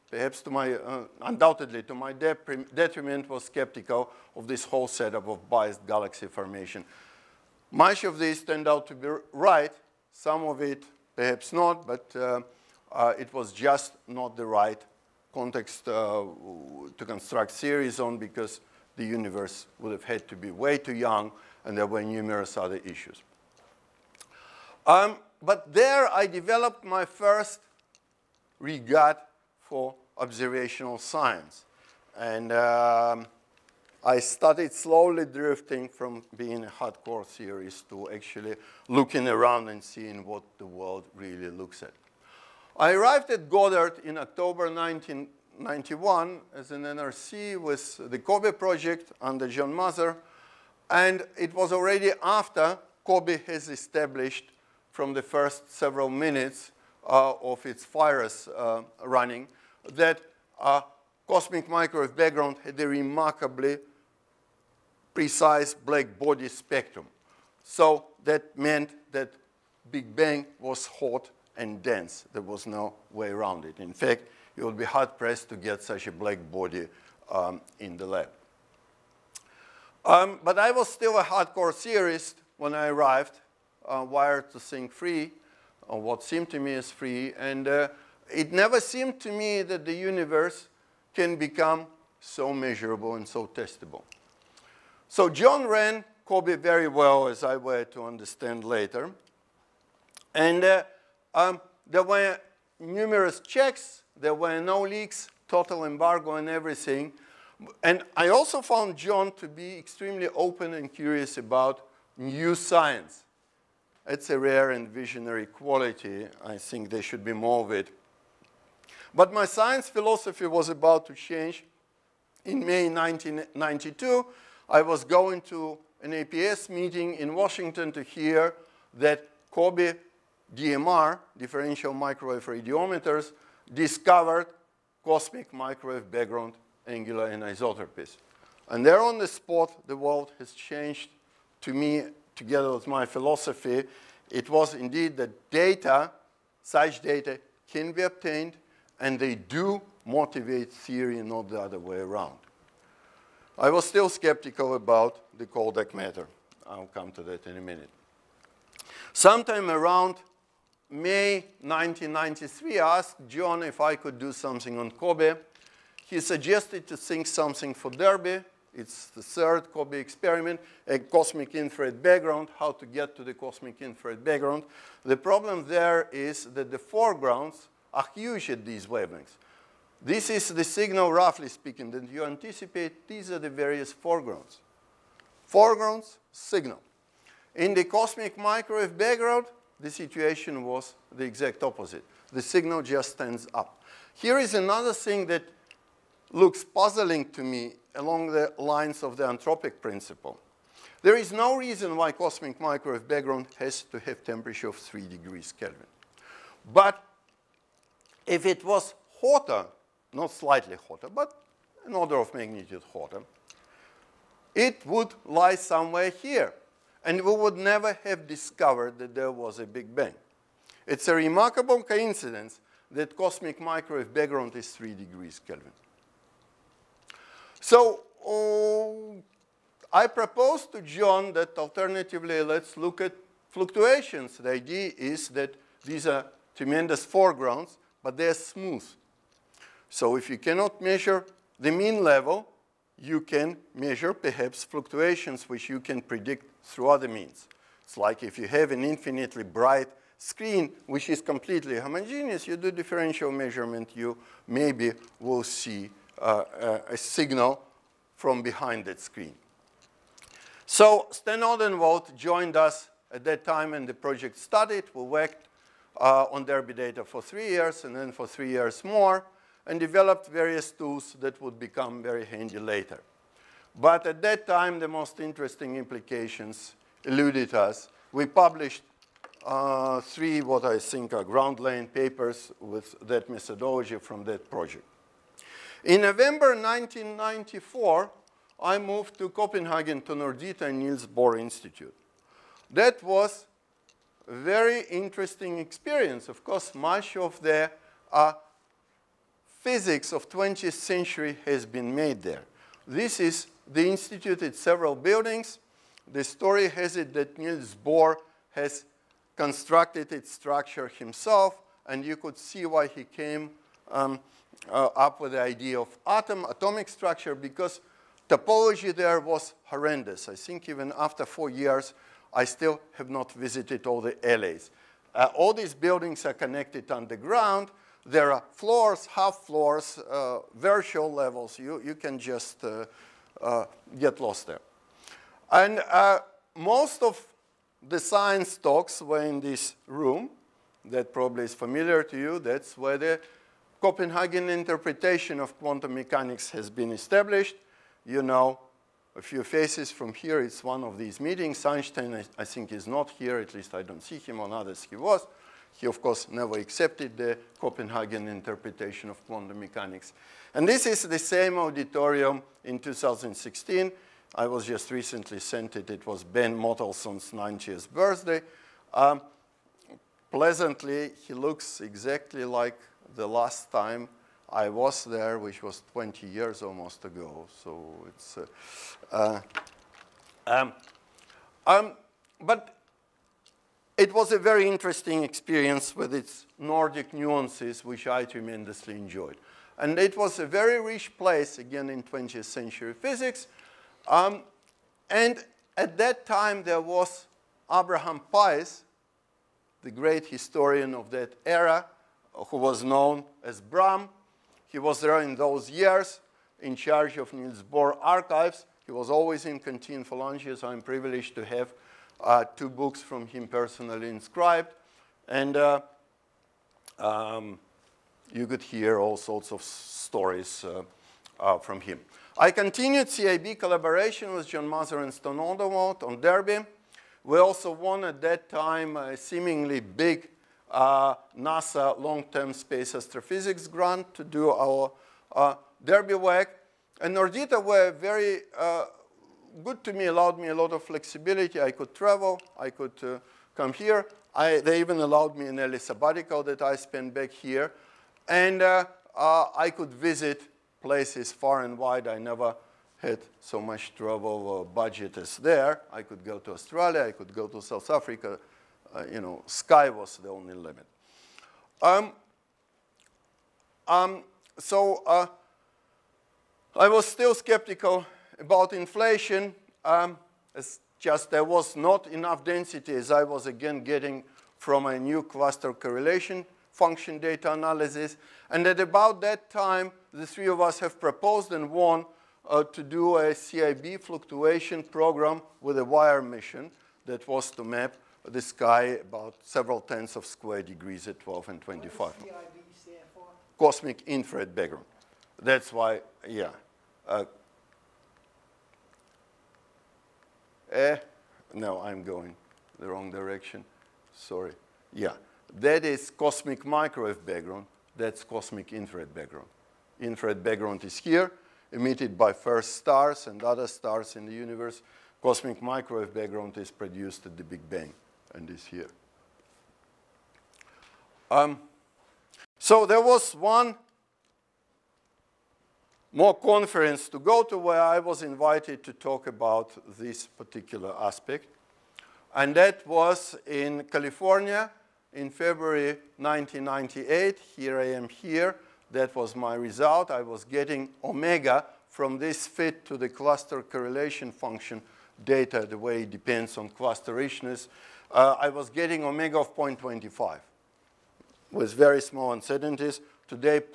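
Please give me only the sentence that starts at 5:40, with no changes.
That probably is familiar to you.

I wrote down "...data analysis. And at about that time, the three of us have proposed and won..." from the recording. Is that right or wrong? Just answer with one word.
right.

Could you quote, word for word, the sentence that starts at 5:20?
I think even after four years, I still have not visited all the LAs.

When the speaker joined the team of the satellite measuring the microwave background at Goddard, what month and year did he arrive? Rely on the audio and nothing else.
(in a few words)
October 1991.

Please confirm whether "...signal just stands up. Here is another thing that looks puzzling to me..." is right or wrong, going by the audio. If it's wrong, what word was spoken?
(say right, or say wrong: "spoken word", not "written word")
right.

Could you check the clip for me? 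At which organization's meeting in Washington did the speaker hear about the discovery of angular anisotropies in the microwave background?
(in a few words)
APS.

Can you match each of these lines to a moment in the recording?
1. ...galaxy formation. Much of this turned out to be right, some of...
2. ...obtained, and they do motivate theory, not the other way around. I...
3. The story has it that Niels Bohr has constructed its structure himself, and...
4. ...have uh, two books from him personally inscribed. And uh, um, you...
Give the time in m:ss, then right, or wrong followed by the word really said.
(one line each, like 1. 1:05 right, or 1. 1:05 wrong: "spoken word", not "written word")
1. 0:05 right
2. 2:28 right
3. 5:06 right
4. 6:51 right.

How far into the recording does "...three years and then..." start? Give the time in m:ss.
4:27.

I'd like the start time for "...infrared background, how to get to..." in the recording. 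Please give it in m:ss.
2:51.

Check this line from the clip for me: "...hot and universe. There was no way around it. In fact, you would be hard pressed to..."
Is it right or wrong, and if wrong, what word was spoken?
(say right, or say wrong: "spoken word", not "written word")
wrong: "dense", not "universe".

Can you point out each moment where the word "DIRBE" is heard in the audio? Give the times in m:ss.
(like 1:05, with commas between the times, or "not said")
2:47, 4:26, 7:06, 7:15.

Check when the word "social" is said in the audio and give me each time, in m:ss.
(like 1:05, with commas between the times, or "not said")
not said.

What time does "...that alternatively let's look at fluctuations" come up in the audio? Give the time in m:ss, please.
3:51.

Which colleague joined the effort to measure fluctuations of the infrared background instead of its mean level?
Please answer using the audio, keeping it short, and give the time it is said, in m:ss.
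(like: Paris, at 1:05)
Stan Odenwald, at 4:21.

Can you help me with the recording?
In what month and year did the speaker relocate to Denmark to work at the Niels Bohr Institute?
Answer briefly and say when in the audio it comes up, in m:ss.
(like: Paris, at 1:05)
November 1994, at 4:46.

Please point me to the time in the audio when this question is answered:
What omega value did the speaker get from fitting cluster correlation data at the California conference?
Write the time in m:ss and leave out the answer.
9:09.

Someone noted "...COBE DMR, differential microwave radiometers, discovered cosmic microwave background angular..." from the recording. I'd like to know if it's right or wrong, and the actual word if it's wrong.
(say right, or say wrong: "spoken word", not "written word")
right.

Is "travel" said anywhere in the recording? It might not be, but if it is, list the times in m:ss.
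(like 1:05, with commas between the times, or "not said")
7:21, 7:33.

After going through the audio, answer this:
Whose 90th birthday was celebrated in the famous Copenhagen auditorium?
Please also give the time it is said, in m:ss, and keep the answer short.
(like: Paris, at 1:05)
Ben Mottelson, at 6:06.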